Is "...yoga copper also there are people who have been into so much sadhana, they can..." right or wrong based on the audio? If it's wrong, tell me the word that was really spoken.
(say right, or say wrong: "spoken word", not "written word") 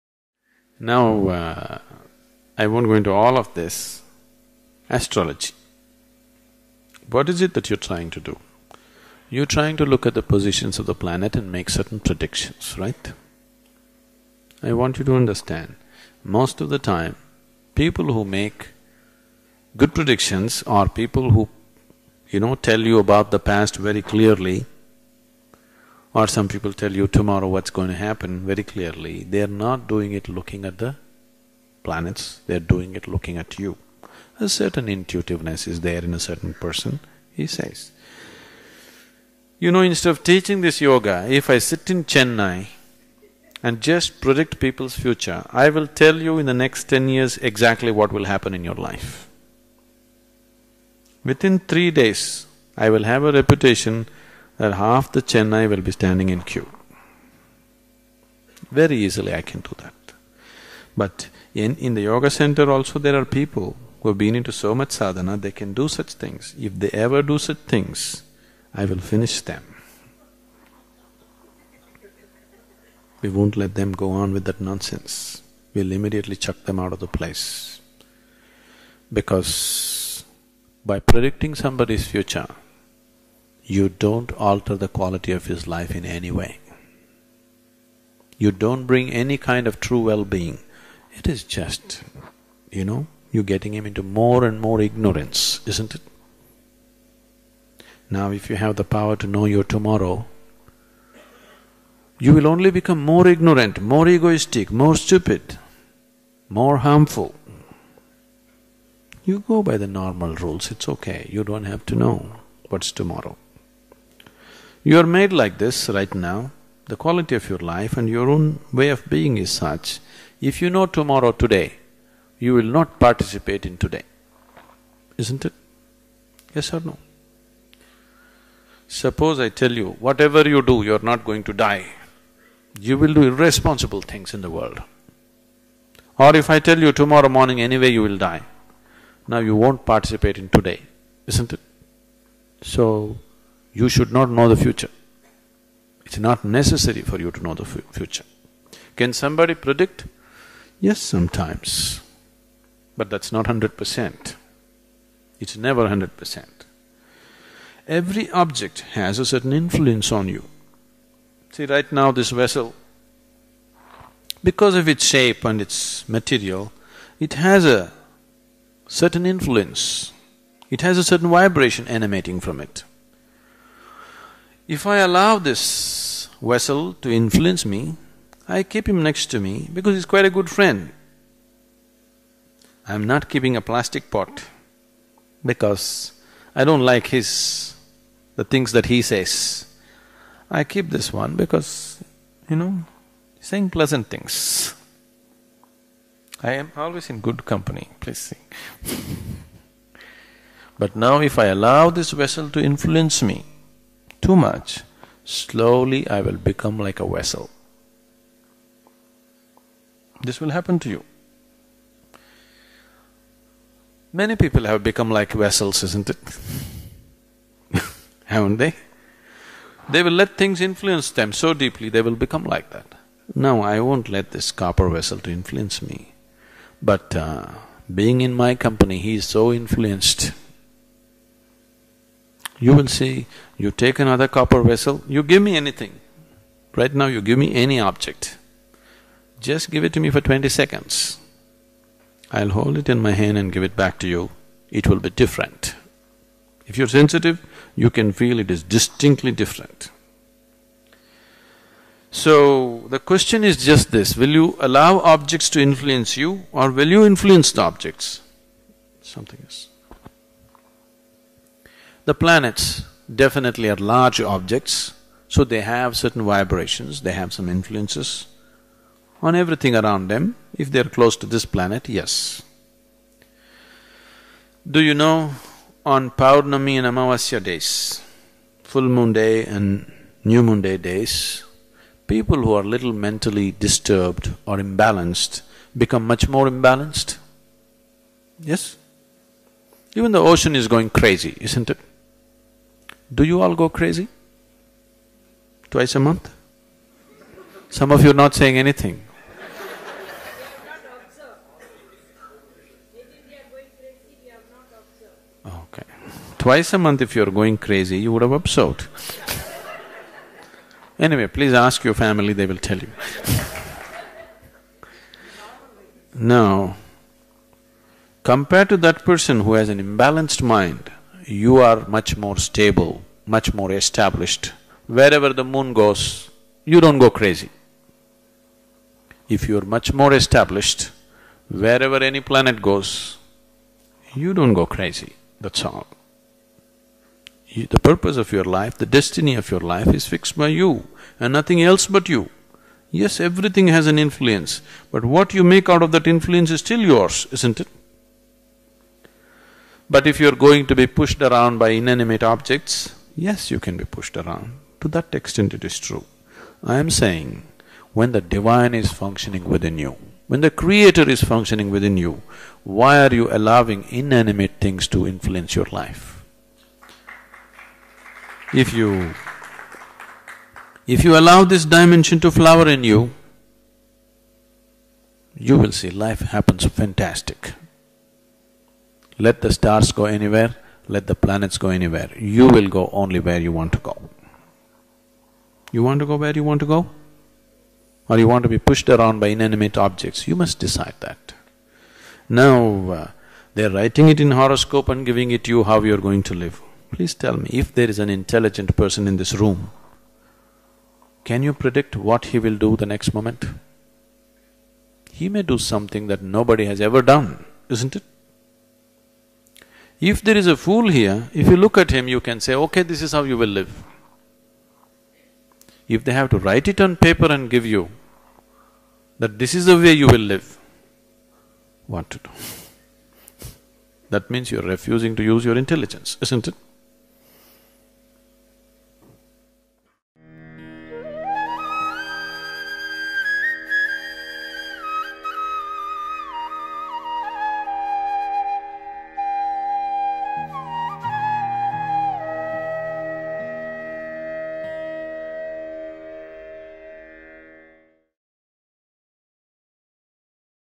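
wrong: "center", not "copper".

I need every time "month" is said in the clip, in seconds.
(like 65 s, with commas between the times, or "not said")
295 s, 306 s.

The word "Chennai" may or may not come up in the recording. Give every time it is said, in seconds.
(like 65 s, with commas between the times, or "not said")
42 s, 55 s.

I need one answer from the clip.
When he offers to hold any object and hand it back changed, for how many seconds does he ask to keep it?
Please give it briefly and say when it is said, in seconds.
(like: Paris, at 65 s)
20, at 240 s.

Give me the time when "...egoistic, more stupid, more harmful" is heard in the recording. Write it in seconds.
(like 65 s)
104 s.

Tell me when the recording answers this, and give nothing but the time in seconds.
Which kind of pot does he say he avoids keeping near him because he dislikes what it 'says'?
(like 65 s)
183 s.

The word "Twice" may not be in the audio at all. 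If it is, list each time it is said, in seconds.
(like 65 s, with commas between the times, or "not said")
295 s, 306 s.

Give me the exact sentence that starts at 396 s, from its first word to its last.
Please tell me, if there is an intelligent person in this room, can you predict what he will do the next moment?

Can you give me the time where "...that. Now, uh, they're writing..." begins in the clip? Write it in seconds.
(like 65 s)
391 s.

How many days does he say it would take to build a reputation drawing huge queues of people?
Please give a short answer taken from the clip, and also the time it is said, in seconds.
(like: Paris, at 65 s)
3, at 51 s.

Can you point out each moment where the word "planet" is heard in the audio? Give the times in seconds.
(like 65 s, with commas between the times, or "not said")
10 s, 31 s, 262 s, 271 s, 332 s, 381 s.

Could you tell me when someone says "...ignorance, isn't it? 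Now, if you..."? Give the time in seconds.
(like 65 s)
94 s.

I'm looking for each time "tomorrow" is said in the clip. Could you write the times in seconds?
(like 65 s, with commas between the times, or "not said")
27 s, 99 s, 112 s, 120 s, 136 s.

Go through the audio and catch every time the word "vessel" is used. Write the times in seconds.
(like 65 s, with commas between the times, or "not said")
162 s, 176 s, 202 s, 207 s, 215 s, 224 s, 234 s.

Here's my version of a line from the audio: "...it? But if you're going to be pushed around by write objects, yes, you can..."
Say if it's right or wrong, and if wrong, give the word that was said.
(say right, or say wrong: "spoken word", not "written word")
wrong: "inanimate", not "write".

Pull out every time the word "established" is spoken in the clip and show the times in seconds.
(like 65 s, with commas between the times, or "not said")
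323 s, 330 s.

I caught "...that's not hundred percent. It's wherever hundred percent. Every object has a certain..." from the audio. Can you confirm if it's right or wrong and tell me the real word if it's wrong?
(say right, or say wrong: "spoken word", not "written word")
wrong: "never", not "wherever".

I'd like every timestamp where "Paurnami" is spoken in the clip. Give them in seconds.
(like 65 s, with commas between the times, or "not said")
276 s.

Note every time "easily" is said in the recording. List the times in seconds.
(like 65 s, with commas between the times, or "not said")
59 s.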